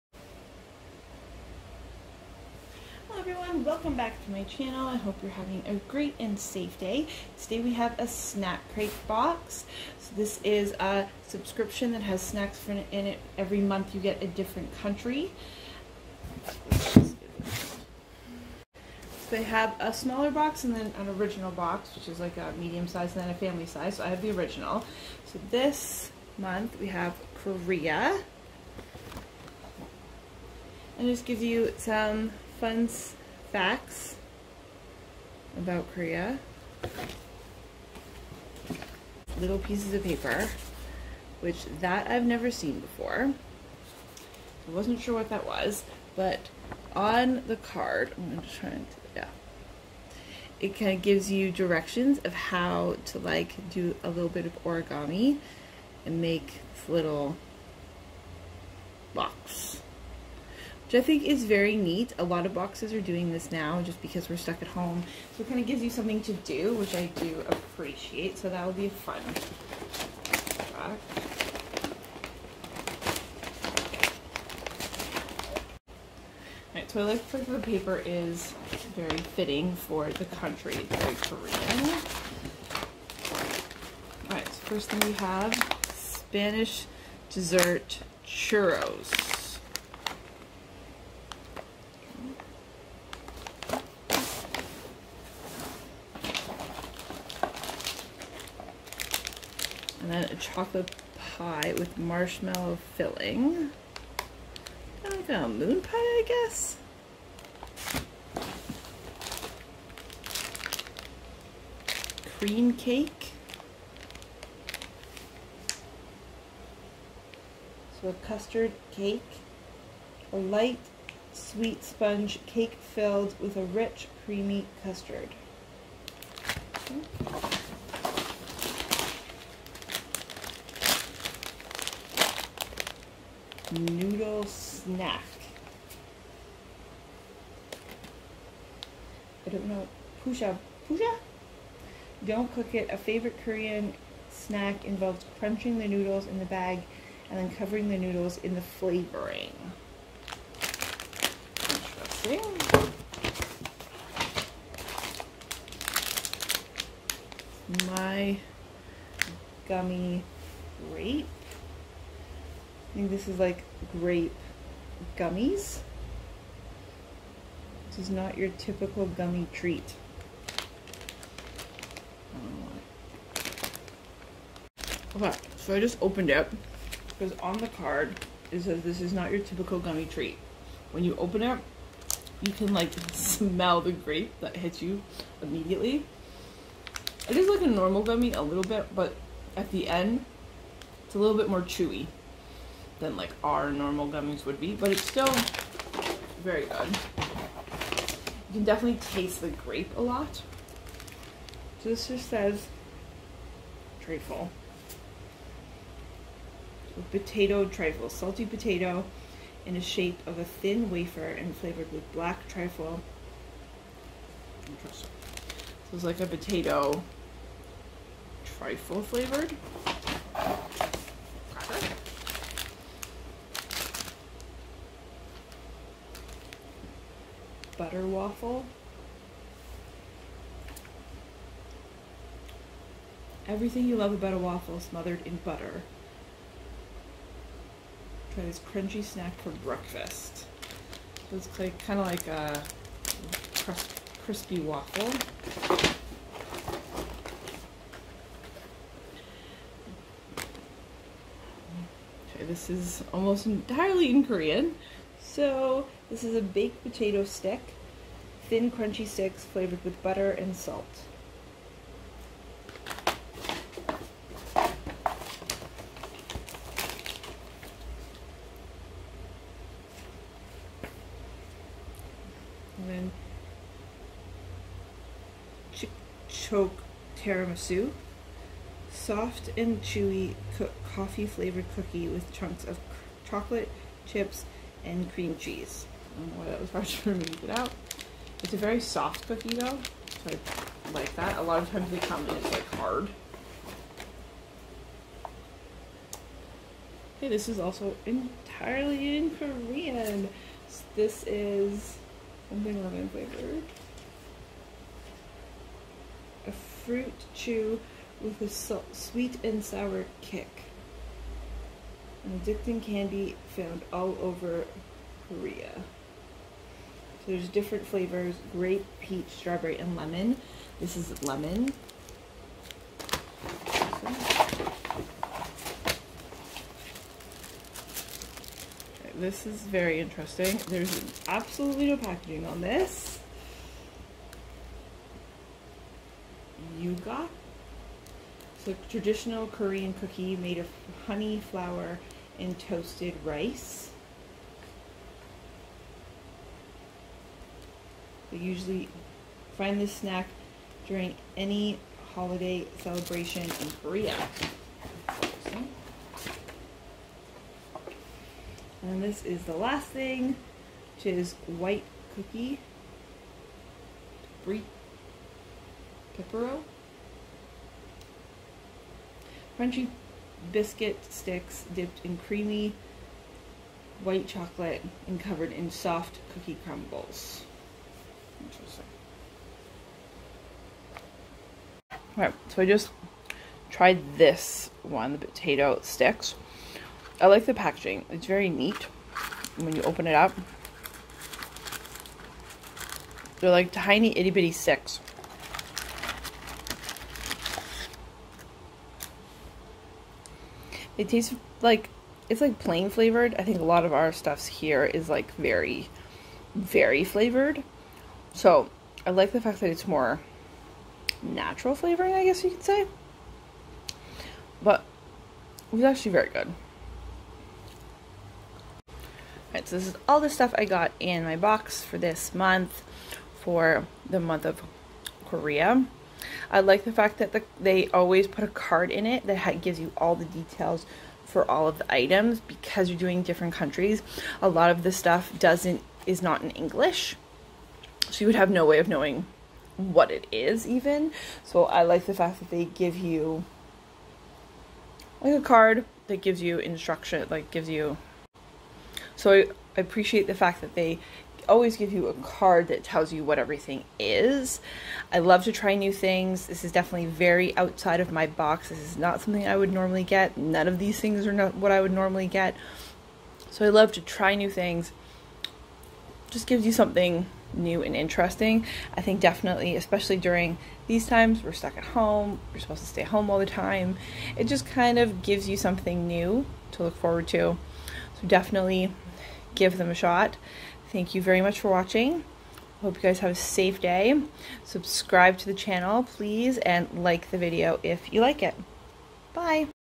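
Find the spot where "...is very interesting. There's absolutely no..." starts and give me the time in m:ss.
5:29.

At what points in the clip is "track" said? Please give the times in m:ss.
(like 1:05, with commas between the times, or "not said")
1:09.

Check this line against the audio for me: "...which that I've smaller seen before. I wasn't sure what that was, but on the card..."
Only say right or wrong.
wrong.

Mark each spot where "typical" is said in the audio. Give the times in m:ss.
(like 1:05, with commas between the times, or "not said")
2:48, 2:59.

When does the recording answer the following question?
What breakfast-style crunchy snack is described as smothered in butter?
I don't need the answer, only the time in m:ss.
3:47.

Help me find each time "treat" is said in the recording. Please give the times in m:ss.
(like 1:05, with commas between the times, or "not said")
2:49, 3:00.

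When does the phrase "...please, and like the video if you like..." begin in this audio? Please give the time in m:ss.
8:06.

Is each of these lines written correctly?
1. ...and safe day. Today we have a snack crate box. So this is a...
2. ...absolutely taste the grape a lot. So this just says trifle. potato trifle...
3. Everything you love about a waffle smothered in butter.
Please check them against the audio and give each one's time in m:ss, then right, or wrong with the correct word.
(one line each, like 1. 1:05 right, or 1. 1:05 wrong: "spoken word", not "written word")
1. 0:06 right
2. 3:18 wrong: "definitely", not "absolutely"
3. 3:53 right.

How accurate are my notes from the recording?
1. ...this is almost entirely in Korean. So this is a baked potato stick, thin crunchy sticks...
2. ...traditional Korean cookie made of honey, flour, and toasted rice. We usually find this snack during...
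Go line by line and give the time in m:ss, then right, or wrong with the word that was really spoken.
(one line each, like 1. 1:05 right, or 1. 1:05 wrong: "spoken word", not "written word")
1. 4:12 right
2. 5:38 right.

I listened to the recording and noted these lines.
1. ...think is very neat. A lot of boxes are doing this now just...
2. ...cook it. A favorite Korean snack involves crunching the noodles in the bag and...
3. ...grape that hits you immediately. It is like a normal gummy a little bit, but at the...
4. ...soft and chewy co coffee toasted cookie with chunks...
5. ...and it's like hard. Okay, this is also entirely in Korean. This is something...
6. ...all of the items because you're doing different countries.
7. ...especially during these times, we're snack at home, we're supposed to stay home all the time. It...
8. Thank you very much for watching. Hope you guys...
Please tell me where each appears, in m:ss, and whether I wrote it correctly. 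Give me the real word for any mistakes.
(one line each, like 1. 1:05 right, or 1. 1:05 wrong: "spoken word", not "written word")
1. 1:01 right
2. 2:22 right
3. 3:03 right
4. 4:38 wrong: "flavored", not "toasted"
5. 4:52 right
6. 7:11 right
7. 7:49 wrong: "stuck", not "snack"
8. 8:00 right.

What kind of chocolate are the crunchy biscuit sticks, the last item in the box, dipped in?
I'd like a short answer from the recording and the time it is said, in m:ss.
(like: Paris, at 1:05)
White chocolate, at 6:12.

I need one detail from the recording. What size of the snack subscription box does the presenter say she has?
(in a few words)
The original.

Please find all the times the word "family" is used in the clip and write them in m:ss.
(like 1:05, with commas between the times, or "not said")
0:23.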